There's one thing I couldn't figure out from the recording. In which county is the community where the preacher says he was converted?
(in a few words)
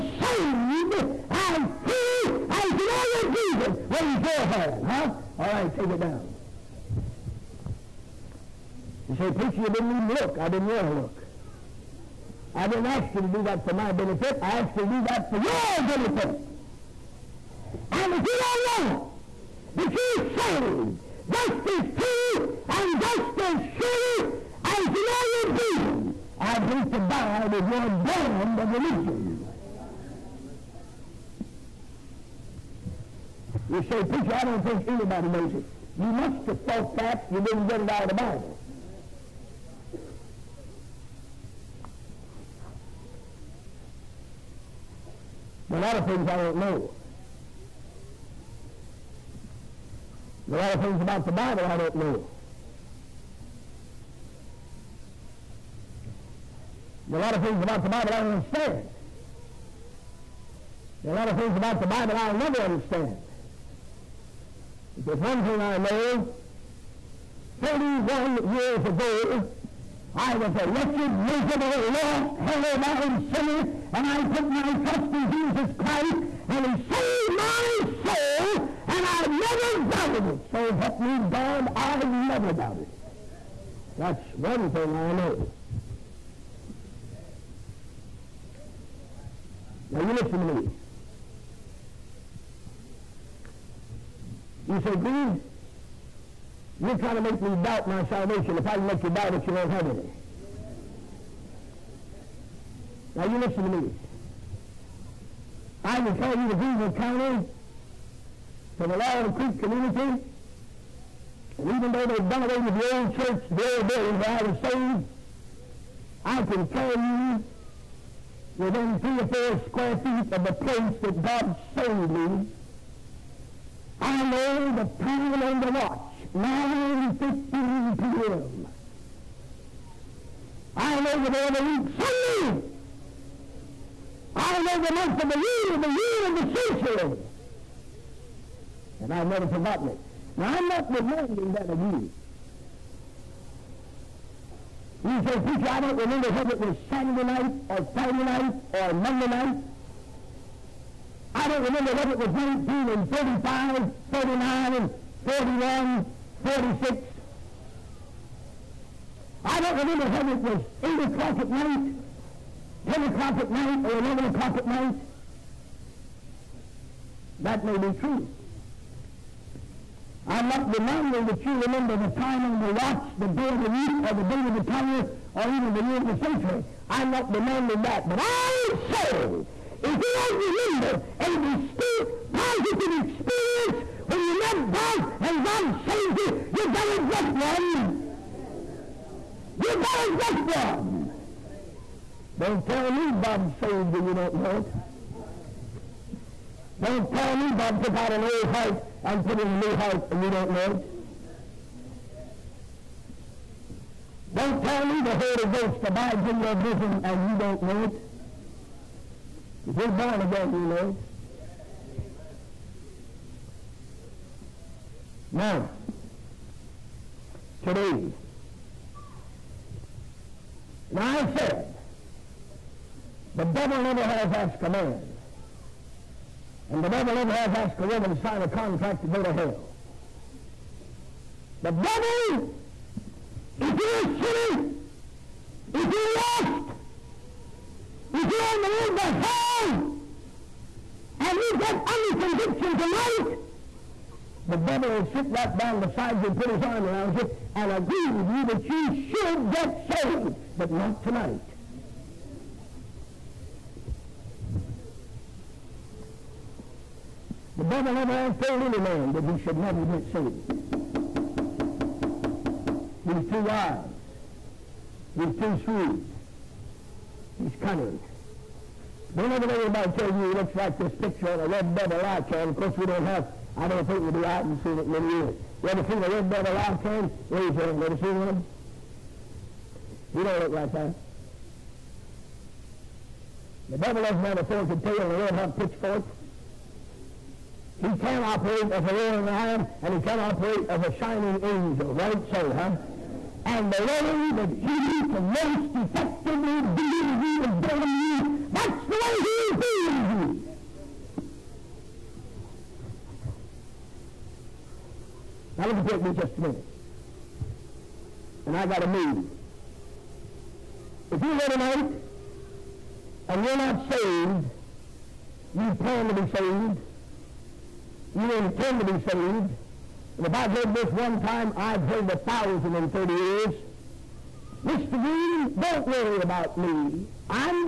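Greenville County.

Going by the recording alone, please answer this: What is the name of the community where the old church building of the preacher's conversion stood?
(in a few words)
Laurel Creek.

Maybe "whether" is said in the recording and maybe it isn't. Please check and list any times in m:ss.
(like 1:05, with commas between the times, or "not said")
2:26, 2:31, 2:40.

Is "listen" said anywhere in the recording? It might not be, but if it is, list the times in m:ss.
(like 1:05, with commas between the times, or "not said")
1:30, 1:43.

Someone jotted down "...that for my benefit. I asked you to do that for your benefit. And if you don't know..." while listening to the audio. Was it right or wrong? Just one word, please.
right.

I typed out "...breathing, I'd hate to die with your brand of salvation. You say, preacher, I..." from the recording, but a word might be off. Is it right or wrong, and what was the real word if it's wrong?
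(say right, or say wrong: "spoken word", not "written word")
wrong: "religion", not "salvation".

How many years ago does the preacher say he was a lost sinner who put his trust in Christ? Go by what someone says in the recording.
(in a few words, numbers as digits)
31.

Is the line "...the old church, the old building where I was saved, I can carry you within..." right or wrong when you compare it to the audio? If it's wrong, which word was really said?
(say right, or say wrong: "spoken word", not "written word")
right.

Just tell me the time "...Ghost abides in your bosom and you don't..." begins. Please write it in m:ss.
3:25.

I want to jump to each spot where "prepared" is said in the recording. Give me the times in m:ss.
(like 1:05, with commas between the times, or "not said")
not said.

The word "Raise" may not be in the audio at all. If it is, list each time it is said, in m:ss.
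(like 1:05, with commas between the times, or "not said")
0:03, 4:37.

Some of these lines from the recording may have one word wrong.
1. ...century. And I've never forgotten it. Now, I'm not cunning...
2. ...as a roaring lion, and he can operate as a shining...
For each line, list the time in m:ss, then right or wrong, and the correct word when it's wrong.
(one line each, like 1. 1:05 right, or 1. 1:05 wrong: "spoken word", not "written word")
1. 2:16 wrong: "demanding", not "cunning"
2. 4:48 right.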